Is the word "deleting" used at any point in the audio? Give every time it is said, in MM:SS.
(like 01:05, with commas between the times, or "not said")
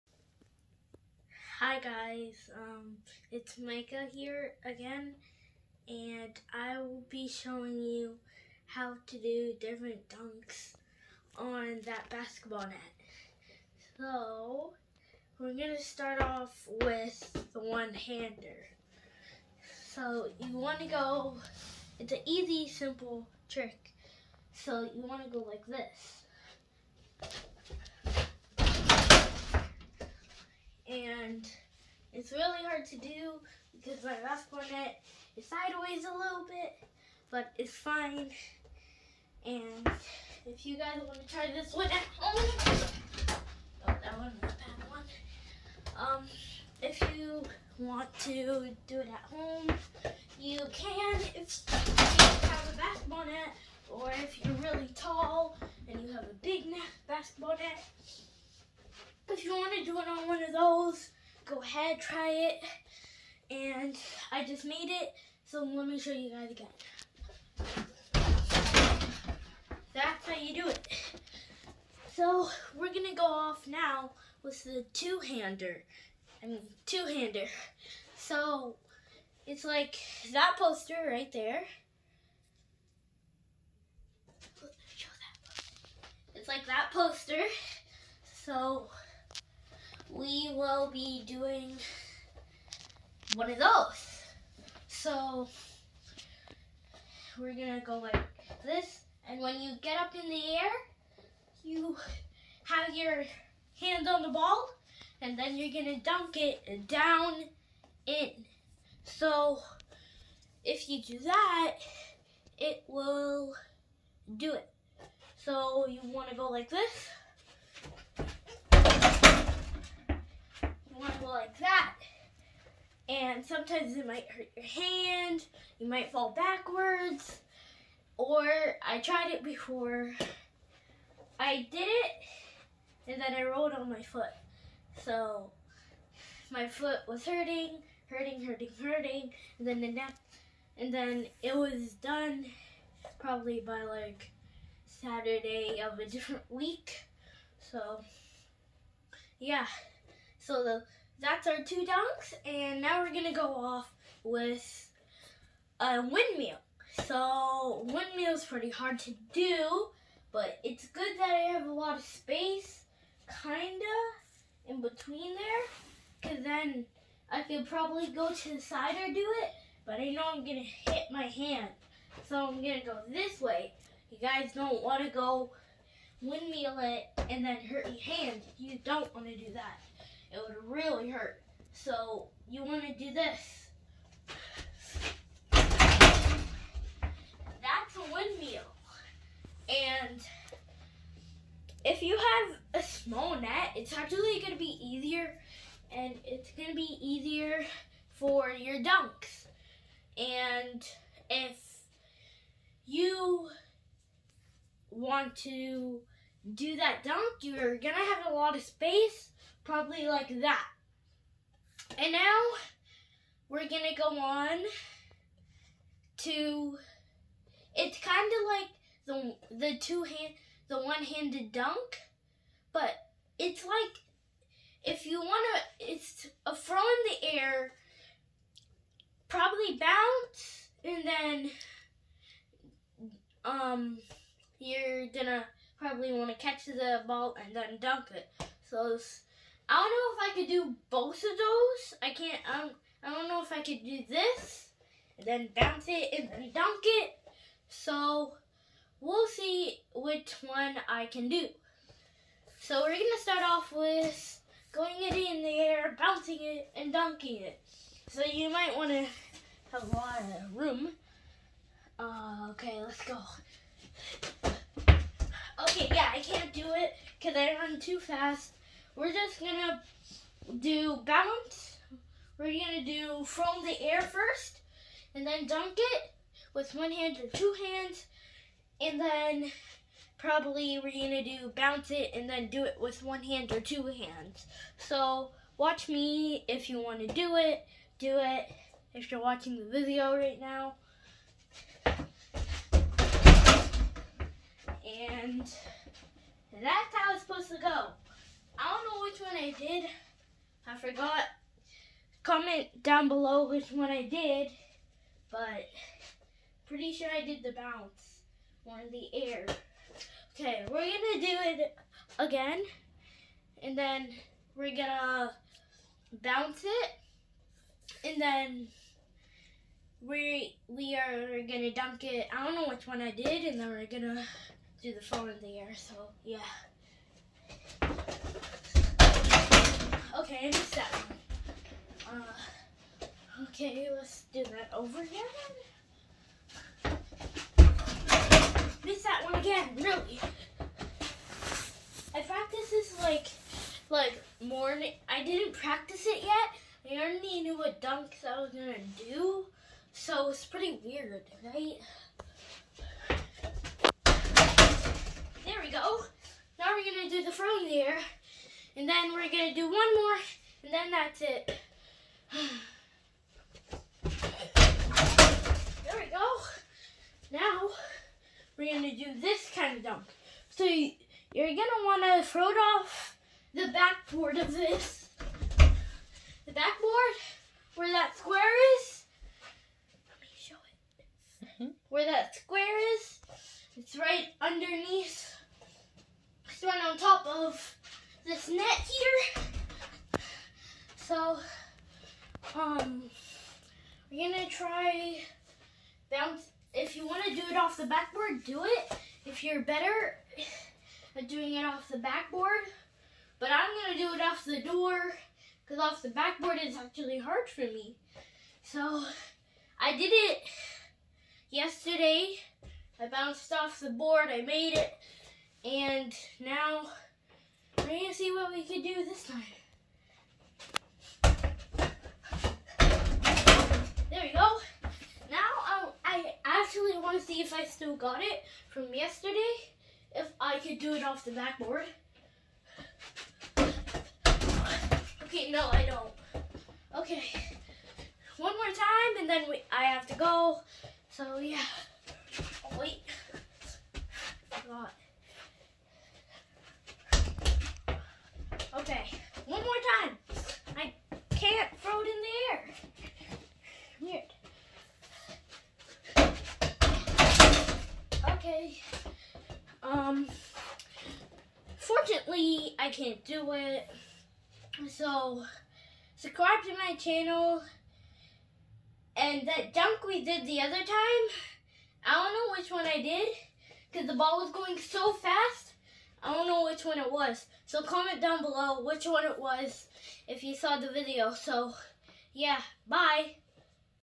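not said.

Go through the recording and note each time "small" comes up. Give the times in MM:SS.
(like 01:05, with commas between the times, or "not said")
03:12.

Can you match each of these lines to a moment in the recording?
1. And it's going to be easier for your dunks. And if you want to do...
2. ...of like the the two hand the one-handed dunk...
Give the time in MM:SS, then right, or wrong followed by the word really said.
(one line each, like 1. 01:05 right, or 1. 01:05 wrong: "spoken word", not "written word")
1. 03:15 right
2. 03:38 right.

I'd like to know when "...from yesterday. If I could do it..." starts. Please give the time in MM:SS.
07:08.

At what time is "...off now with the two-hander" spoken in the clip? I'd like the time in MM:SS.
01:13.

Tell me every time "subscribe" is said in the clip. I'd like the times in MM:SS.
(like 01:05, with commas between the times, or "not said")
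07:46.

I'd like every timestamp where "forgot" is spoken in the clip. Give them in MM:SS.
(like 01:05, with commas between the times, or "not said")
05:00, 07:24.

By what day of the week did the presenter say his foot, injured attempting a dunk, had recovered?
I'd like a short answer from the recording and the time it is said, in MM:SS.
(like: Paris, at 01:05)
Saturday, at 02:24.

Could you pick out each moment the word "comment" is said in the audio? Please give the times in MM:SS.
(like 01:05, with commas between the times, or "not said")
05:02, 07:57.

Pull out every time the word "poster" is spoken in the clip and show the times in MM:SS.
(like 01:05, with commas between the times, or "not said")
01:20, 01:26.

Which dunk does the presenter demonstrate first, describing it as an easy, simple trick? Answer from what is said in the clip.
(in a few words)
One-hander.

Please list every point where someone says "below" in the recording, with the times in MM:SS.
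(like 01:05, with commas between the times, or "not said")
05:03, 07:58.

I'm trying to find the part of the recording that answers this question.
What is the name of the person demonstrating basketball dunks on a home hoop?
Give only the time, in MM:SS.
00:03.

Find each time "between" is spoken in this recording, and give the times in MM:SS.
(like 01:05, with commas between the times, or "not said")
02:44.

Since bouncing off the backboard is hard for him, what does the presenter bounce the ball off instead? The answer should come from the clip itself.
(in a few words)
The door.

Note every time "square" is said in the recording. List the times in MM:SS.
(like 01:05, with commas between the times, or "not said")
06:18, 06:22.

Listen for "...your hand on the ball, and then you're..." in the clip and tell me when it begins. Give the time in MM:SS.
01:42.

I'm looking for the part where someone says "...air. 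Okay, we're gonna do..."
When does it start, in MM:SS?
05:09.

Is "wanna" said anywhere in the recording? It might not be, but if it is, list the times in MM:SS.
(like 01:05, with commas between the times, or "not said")
01:56, 04:18, 04:46, 06:37.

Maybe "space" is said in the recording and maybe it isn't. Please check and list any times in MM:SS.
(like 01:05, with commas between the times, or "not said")
02:42, 03:28.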